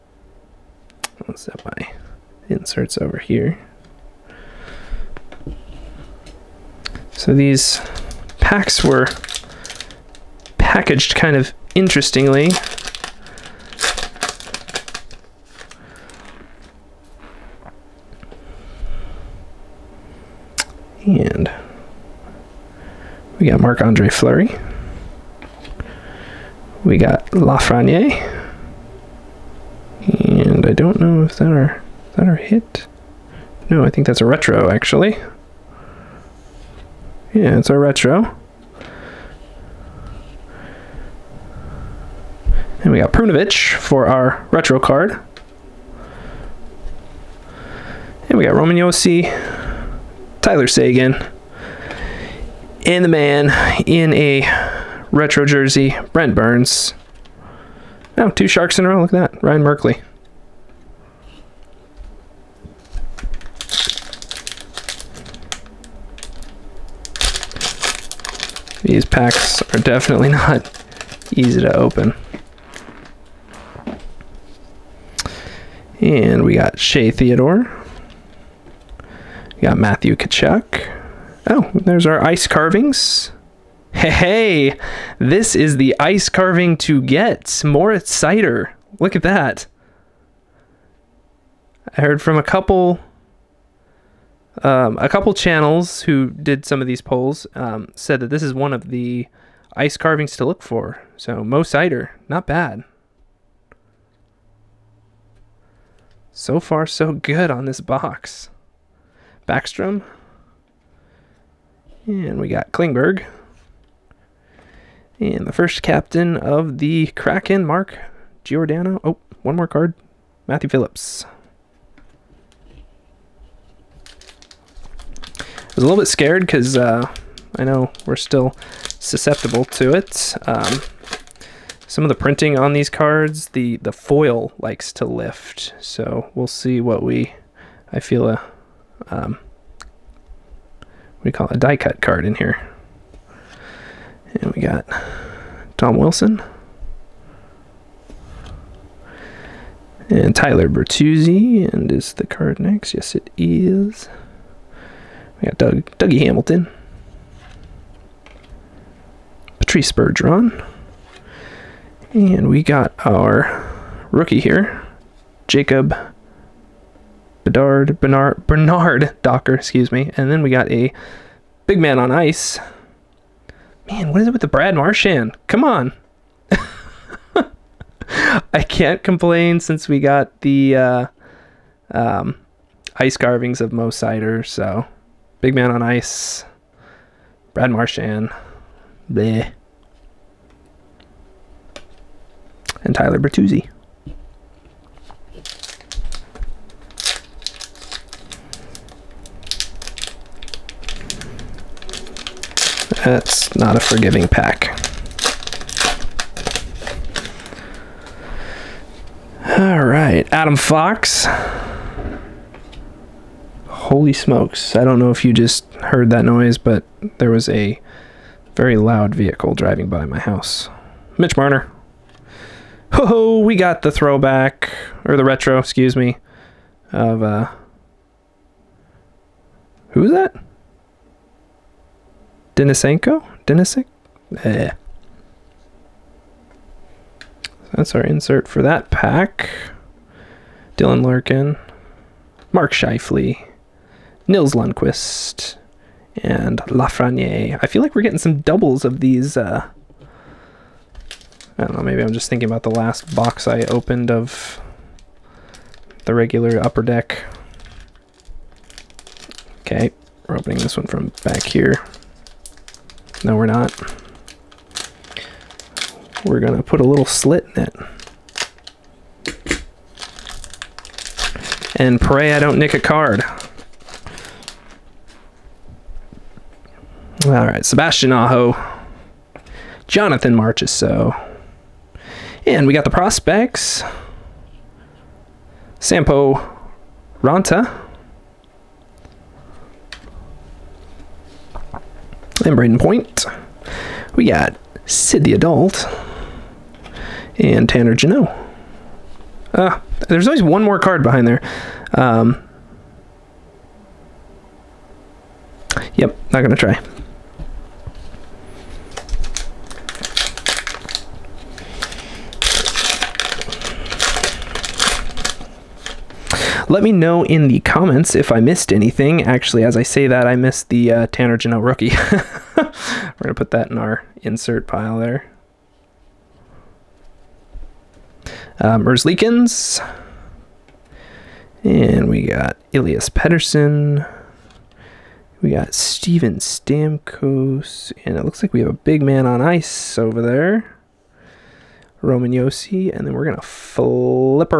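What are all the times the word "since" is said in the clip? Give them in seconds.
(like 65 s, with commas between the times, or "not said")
179 s.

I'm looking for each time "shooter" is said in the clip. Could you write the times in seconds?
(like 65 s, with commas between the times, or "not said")
not said.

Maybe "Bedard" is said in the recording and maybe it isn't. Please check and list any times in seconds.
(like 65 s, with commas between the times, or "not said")
167 s.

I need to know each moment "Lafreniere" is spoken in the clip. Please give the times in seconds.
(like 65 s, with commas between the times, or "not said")
27 s, 246 s.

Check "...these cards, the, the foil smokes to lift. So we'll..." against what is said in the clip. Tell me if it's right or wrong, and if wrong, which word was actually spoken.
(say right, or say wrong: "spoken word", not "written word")
wrong: "likes", not "smokes".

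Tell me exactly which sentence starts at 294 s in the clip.
We got Sid the Adult and Tanner Jeannot.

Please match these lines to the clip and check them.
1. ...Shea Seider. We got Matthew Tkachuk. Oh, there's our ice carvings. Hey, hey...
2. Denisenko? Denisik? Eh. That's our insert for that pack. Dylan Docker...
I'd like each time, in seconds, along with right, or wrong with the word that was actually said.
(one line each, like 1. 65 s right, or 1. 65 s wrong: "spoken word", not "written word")
1. 76 s wrong: "Theodore", not "Seider"
2. 232 s wrong: "Larkin", not "Docker".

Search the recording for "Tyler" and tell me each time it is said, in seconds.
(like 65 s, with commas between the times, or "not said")
50 s, 150 s, 192 s.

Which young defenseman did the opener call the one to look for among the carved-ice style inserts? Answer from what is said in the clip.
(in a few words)
Moritz Seider.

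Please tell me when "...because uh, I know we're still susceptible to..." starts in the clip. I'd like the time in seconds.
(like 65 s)
126 s.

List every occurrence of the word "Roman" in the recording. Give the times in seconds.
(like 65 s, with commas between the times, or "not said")
48 s, 342 s.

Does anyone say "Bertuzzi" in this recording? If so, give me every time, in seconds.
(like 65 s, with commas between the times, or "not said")
150 s, 193 s.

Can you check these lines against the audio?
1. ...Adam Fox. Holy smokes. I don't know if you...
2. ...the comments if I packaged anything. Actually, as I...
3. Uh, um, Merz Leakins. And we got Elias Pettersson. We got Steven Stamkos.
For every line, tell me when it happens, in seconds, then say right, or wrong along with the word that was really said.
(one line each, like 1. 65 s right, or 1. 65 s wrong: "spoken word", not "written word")
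1. 210 s right
2. 317 s wrong: "missed", not "packaged"
3. 328 s right.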